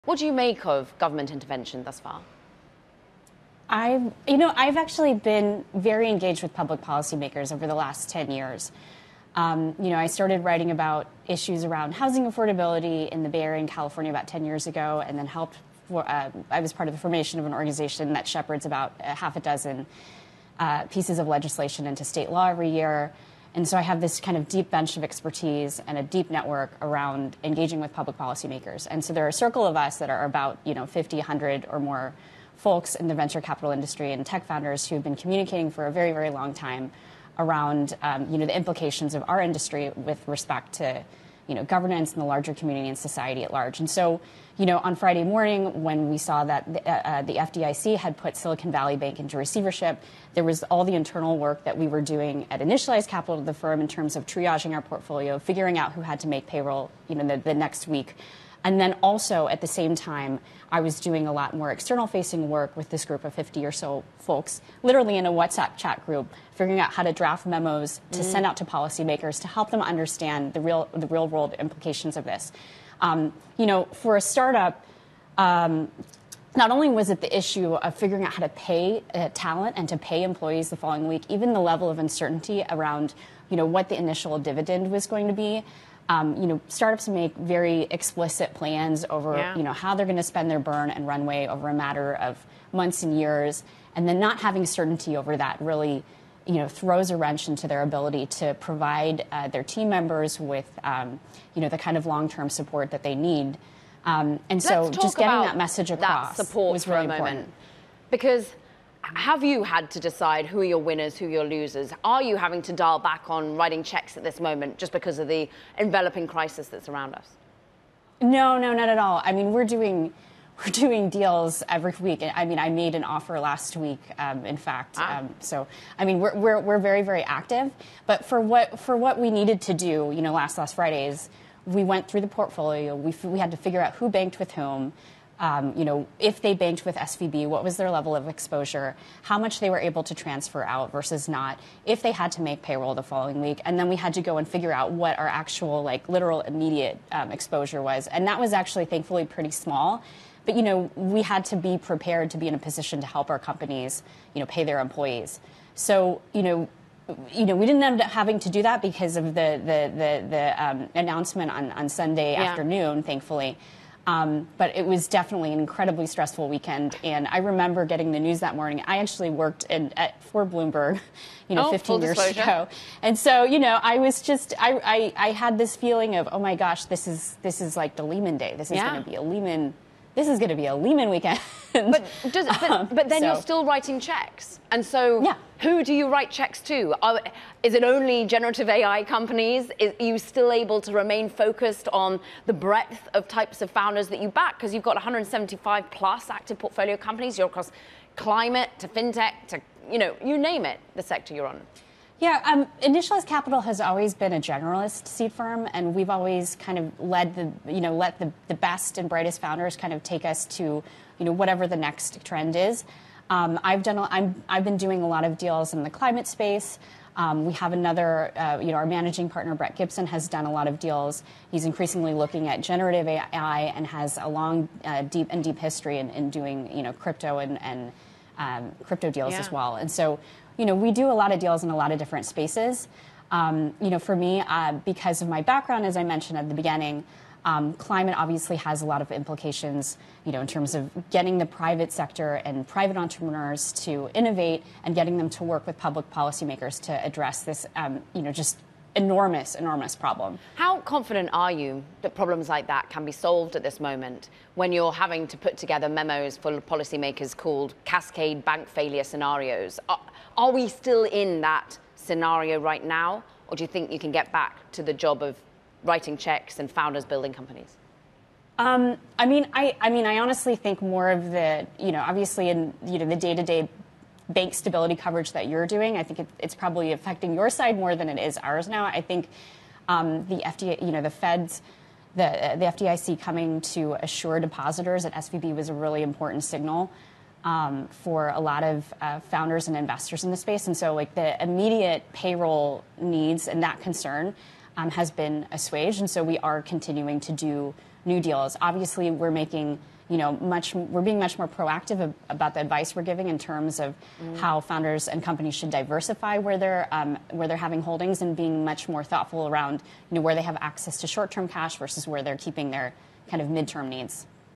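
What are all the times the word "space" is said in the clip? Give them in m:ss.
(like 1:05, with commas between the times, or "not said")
3:36, 3:52, 4:50.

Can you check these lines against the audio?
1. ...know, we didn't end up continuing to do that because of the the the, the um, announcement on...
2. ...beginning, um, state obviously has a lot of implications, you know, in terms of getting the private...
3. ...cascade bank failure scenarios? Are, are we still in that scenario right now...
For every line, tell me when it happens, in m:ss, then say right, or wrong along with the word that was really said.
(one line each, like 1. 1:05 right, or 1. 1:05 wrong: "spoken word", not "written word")
1. 2:37 wrong: "having", not "continuing"
2. 3:56 wrong: "climate", not "state"
3. 4:17 right.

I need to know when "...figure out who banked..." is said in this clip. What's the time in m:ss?
2:13.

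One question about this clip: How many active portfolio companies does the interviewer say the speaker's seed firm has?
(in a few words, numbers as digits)
175.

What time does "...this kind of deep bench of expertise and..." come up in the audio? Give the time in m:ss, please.
0:23.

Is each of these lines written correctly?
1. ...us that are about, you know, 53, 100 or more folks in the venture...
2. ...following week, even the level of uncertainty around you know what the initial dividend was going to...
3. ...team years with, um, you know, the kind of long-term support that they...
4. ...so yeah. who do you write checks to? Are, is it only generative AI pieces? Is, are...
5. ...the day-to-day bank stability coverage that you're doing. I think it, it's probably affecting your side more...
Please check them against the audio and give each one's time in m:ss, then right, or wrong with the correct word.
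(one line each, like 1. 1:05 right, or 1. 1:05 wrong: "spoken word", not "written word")
1. 0:29 wrong: "50", not "53"
2. 1:20 right
3. 1:39 wrong: "members", not "years"
4. 3:04 wrong: "companies", not "pieces"
5. 4:33 right.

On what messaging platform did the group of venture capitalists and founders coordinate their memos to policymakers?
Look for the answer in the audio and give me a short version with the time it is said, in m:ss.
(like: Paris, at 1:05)
WhatsApp, at 1:05.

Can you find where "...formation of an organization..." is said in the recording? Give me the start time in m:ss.
0:16.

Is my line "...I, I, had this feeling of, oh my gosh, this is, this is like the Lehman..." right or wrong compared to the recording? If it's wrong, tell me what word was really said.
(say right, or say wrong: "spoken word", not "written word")
right.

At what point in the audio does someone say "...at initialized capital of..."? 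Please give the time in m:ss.
0:52.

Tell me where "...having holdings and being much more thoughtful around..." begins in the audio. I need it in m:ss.
5:07.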